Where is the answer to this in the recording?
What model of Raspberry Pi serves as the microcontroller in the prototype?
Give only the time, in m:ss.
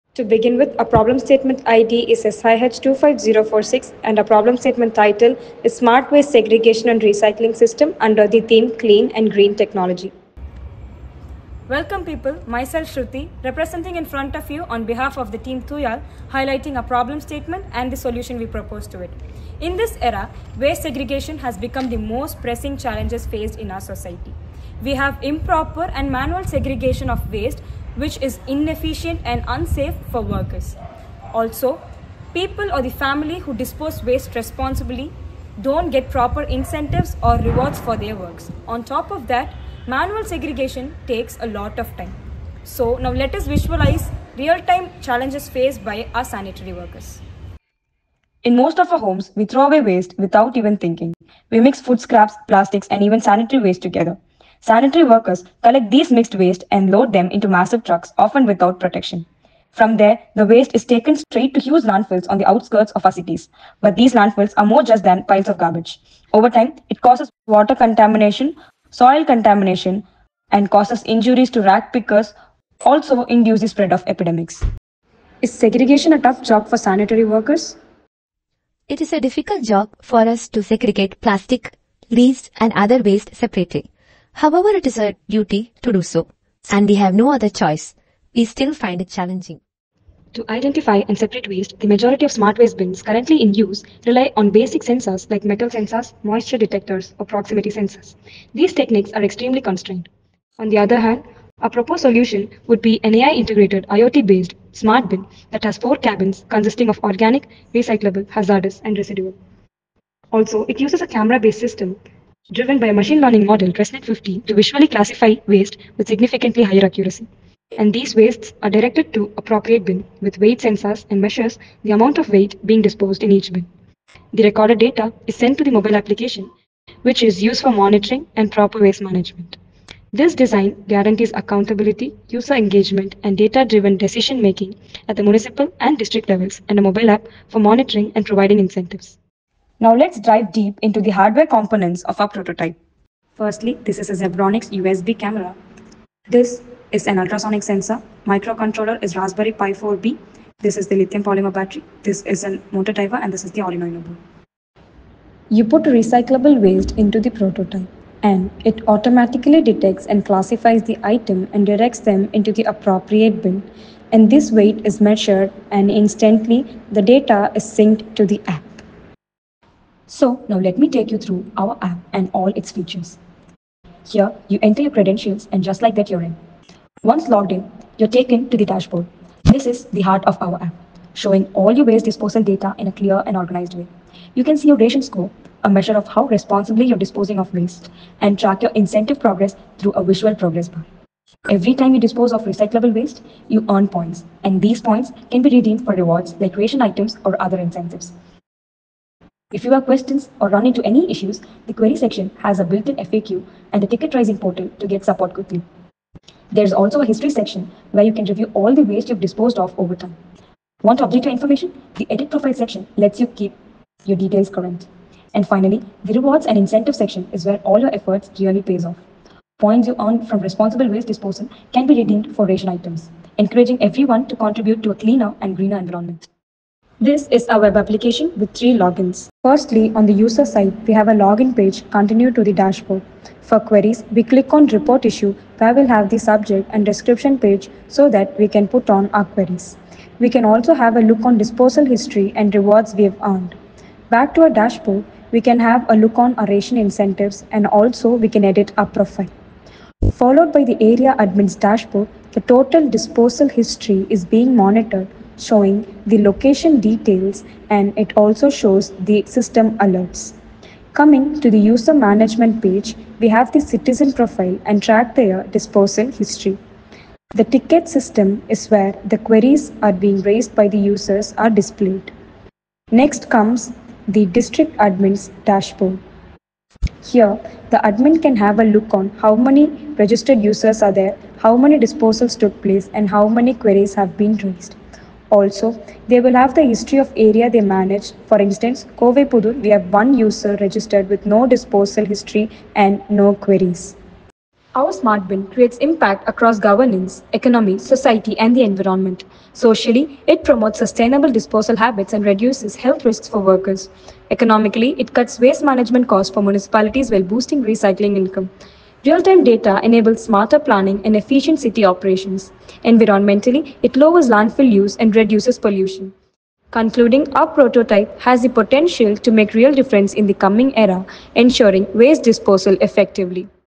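2:29.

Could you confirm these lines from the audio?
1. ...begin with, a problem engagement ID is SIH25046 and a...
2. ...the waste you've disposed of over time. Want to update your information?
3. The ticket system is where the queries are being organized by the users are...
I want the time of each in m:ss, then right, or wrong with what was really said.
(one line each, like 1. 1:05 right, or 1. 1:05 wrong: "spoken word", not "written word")
1. 0:00 wrong: "statement", not "engagement"
2. 3:28 right
3. 4:27 wrong: "raised", not "organized".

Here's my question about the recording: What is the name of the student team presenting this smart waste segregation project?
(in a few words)
Thooyazh.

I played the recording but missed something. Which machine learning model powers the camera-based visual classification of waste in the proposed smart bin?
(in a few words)
ResNet 50.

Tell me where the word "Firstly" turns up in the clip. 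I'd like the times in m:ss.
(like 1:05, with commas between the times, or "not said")
2:23, 3:49.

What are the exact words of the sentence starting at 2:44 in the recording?
And this weight is measured and instantly the data is synced to the app.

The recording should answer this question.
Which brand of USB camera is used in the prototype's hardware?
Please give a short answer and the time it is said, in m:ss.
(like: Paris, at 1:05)
Zebronics, at 2:24.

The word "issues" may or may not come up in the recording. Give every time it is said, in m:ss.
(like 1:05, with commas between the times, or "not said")
3:21, 3:55.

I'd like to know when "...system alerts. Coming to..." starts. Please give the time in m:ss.
4:19.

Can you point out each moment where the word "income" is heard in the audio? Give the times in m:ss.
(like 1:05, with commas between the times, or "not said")
5:08.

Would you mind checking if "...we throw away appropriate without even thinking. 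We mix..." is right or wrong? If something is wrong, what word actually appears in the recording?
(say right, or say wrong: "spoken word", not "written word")
wrong: "waste", not "appropriate".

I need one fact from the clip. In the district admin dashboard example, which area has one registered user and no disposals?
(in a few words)
Kove Pudur.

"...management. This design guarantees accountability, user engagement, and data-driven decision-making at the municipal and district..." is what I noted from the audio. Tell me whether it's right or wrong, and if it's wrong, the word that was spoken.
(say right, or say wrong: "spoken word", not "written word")
right.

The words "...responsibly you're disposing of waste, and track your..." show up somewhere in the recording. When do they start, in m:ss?
3:06.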